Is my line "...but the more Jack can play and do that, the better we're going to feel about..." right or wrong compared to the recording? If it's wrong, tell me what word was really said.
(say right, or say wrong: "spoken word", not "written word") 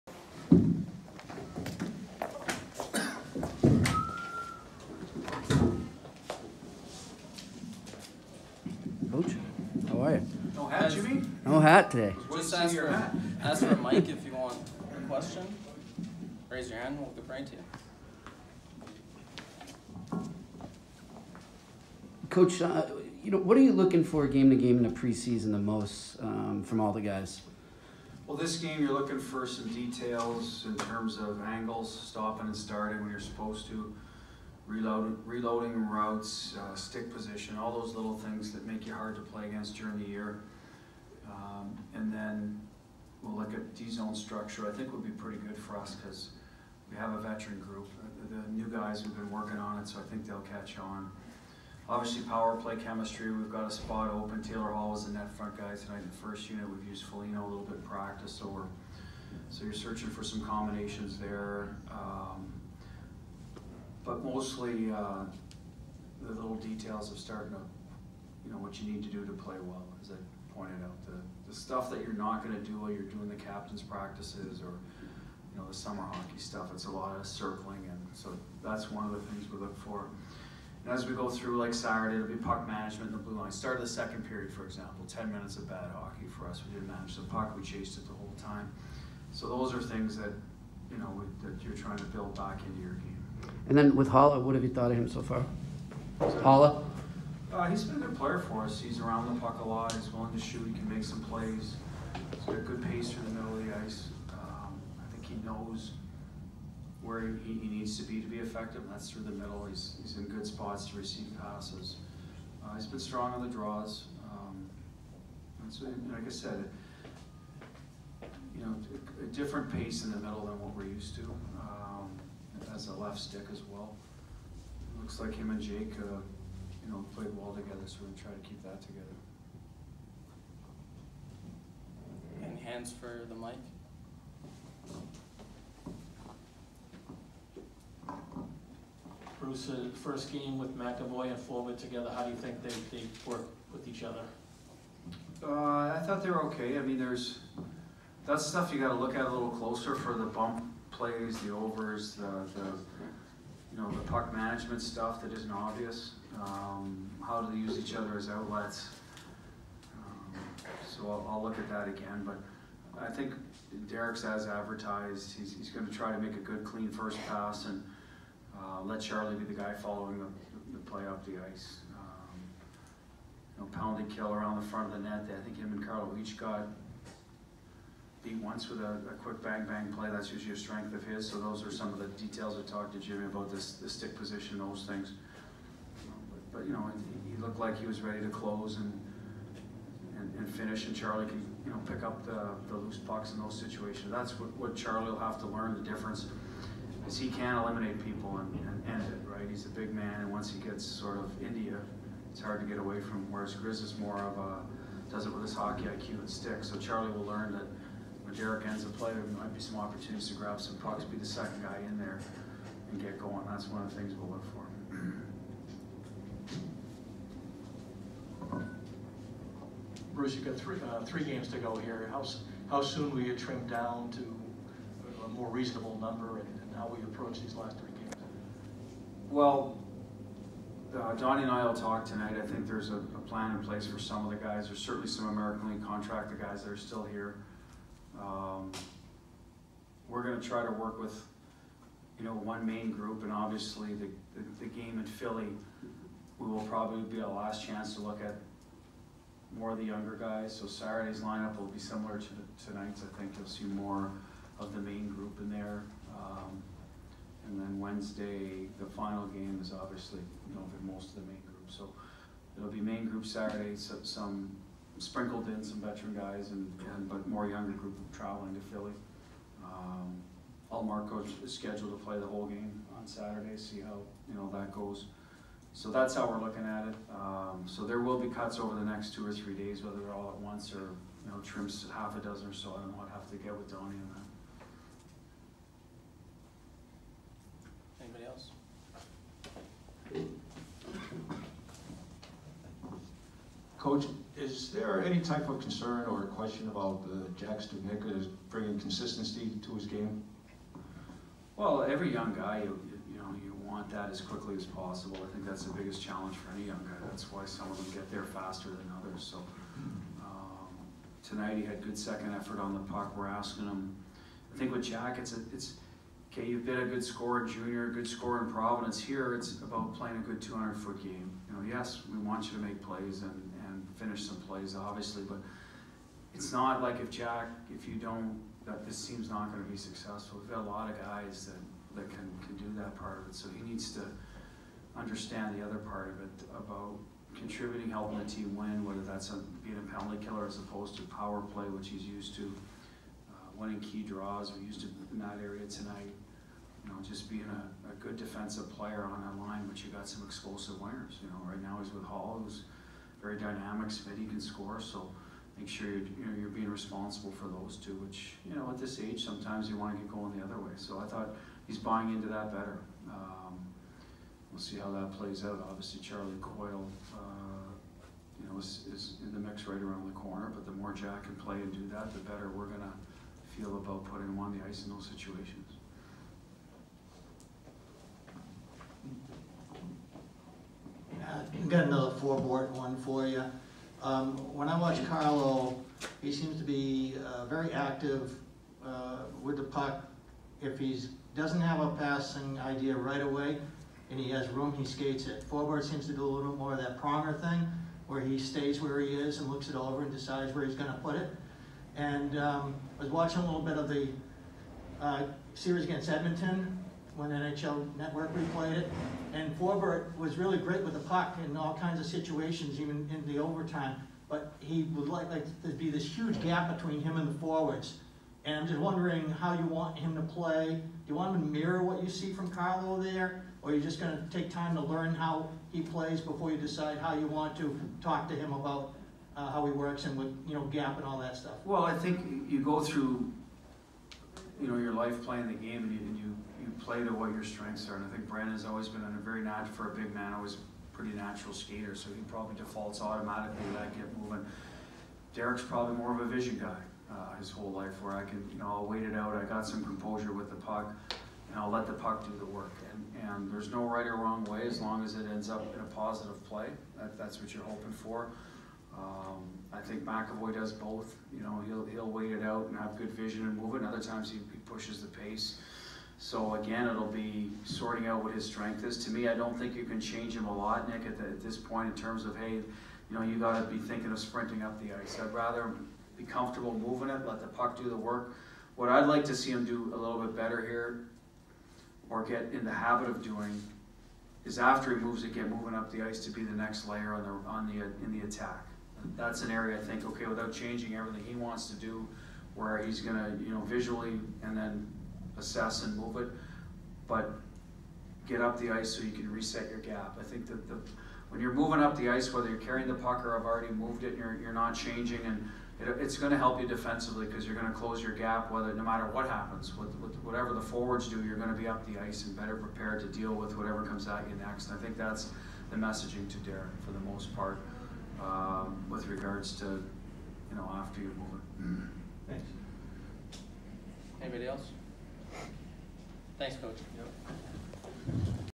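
right.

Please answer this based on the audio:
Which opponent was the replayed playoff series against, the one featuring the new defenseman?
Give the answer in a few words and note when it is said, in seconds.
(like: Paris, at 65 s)
Edmonton, at 406 s.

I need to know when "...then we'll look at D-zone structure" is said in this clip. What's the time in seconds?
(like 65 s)
42 s.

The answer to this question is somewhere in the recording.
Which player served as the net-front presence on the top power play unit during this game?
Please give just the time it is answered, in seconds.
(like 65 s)
54 s.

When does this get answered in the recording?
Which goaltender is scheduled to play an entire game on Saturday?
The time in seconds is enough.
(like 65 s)
270 s.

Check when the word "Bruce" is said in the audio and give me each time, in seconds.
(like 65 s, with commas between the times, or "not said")
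139 s, 220 s.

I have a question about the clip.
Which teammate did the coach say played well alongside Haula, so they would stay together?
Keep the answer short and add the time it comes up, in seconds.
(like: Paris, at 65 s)
Jake, at 125 s.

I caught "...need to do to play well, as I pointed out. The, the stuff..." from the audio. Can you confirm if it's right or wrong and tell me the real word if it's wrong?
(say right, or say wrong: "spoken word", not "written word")
right.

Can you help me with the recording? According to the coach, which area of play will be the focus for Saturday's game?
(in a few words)
puck management in the blue line.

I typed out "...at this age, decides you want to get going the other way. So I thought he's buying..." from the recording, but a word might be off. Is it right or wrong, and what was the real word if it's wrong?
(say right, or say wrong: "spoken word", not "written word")
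wrong: "sometimes", not "decides".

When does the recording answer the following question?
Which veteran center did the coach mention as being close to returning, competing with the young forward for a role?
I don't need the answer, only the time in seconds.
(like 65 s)
366 s.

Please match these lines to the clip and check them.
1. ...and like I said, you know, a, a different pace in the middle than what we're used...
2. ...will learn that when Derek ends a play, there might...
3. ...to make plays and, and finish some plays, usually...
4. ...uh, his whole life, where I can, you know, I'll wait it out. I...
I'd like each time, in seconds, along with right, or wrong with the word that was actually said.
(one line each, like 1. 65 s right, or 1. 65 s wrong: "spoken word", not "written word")
1. 115 s right
2. 207 s right
3. 322 s wrong: "obviously", not "usually"
4. 447 s right.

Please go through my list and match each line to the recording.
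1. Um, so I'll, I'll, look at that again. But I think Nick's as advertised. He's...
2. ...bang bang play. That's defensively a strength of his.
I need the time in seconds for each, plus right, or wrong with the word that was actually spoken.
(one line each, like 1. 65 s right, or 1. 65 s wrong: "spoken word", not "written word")
1. 159 s wrong: "Derek", not "Nick"
2. 179 s wrong: "usually", not "defensively".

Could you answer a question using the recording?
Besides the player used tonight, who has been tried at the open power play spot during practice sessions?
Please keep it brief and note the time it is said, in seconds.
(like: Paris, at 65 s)
Foligno, at 57 s.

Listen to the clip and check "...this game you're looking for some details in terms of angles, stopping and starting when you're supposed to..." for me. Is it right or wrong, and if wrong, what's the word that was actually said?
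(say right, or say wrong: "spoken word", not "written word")
right.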